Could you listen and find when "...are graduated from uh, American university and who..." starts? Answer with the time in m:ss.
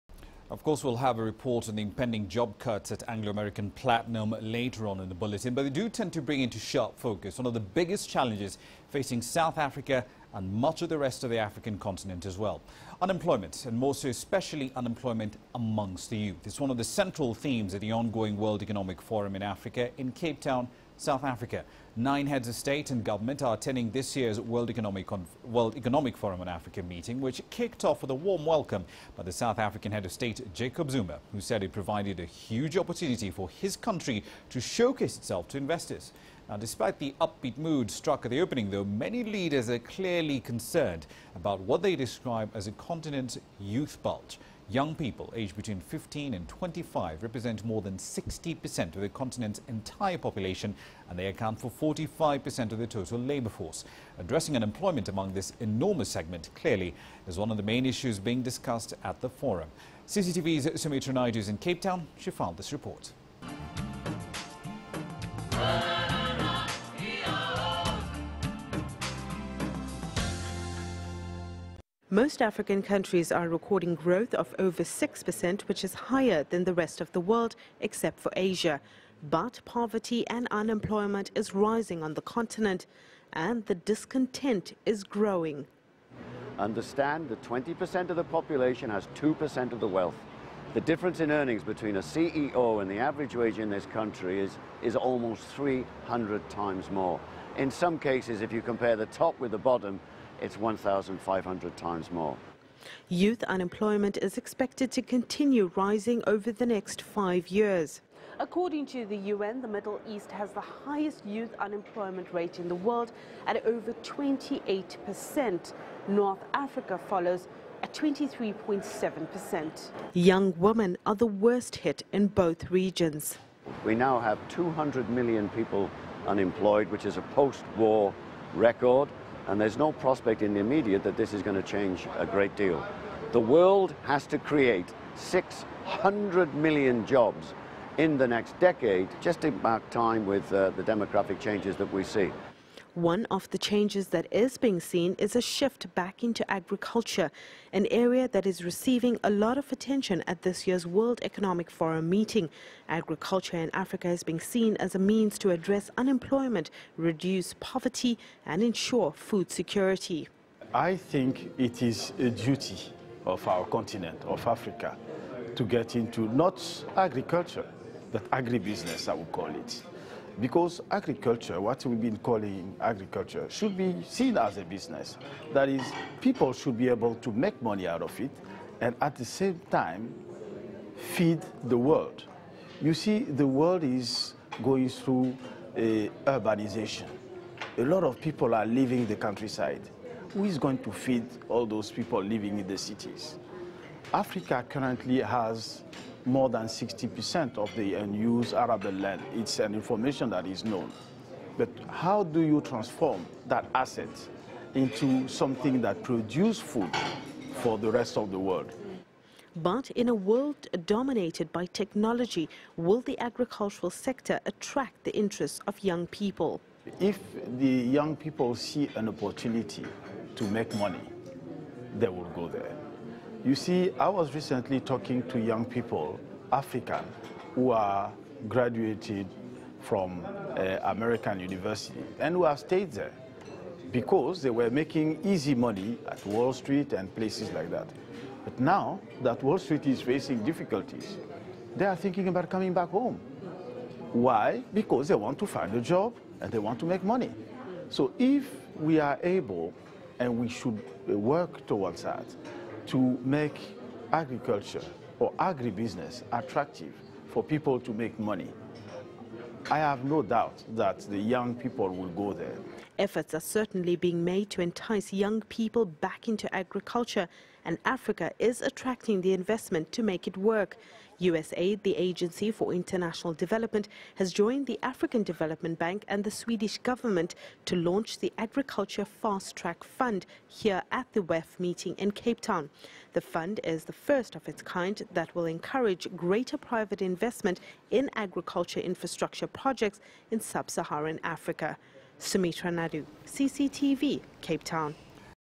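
3:47.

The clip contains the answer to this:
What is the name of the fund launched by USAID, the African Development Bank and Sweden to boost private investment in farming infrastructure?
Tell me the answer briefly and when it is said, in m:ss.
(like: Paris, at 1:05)
Agriculture Fast Track Fund, at 4:38.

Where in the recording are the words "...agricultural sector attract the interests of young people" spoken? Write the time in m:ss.
3:33.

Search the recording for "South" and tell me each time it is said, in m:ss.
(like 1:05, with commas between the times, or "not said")
0:09, 0:20, 0:29.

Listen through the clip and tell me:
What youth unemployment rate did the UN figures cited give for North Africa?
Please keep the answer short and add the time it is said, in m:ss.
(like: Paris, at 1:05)
23.7%, at 1:57.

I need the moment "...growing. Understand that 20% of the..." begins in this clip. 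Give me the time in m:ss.
1:25.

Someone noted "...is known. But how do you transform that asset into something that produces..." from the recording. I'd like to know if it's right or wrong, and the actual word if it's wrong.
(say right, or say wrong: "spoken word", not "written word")
right.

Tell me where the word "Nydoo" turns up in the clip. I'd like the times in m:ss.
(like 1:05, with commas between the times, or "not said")
1:01, 4:52.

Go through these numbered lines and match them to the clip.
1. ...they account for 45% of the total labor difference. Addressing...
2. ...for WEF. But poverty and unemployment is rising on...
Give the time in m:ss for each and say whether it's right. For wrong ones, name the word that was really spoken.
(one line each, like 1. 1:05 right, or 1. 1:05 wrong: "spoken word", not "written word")
1. 0:51 wrong: "force", not "difference"
2. 1:18 wrong: "Asia", not "WEF".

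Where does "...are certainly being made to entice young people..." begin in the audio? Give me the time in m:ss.
4:23.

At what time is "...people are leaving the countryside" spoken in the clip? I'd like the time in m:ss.
3:08.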